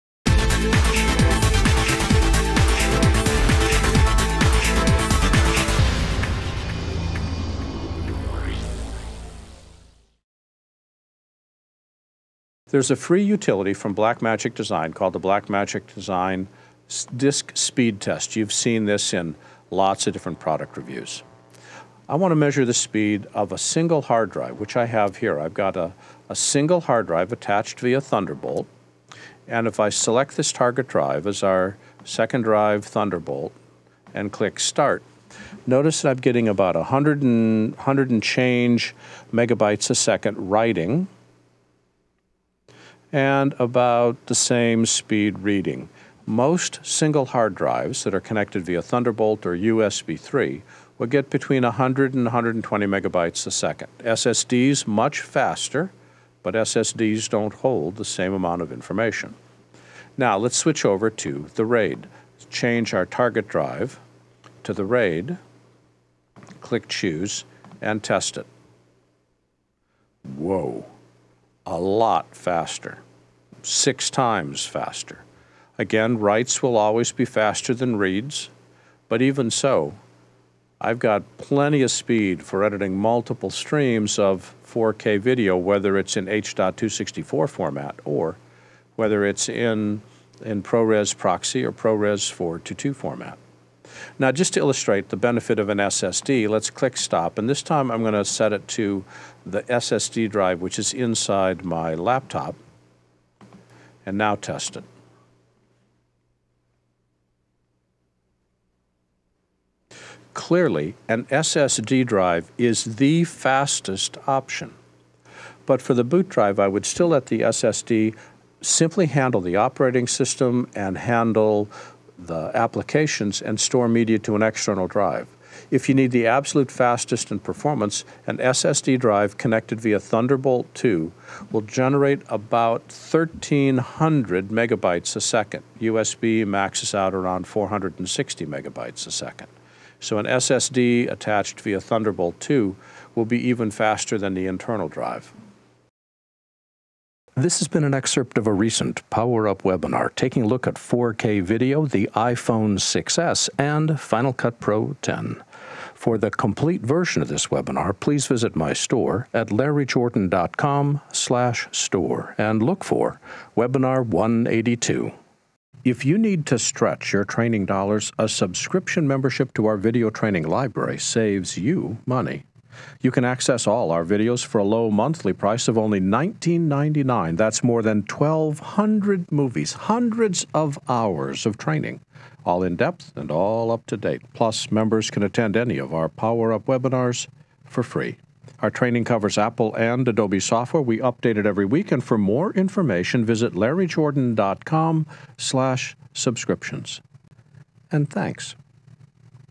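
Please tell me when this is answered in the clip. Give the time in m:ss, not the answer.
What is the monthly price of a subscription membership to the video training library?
2:55.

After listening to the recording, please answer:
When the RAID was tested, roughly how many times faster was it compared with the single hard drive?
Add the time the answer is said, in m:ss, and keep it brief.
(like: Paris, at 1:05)
6 times, at 1:13.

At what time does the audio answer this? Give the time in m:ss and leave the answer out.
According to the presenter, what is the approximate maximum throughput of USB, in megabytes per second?
2:17.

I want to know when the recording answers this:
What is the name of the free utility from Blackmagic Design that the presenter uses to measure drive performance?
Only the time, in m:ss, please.
0:15.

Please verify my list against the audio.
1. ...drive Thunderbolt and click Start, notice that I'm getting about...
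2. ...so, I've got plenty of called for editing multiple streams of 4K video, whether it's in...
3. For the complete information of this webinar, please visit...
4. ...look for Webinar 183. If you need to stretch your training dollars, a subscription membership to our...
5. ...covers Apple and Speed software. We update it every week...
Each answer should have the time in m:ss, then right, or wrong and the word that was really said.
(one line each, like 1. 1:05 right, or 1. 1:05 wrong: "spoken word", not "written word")
1. 0:32 right
2. 1:19 wrong: "speed", not "called"
3. 2:36 wrong: "version", not "information"
4. 2:42 wrong: "182", not "183"
5. 3:09 wrong: "Adobe", not "Speed".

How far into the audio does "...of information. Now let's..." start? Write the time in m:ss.
0:58.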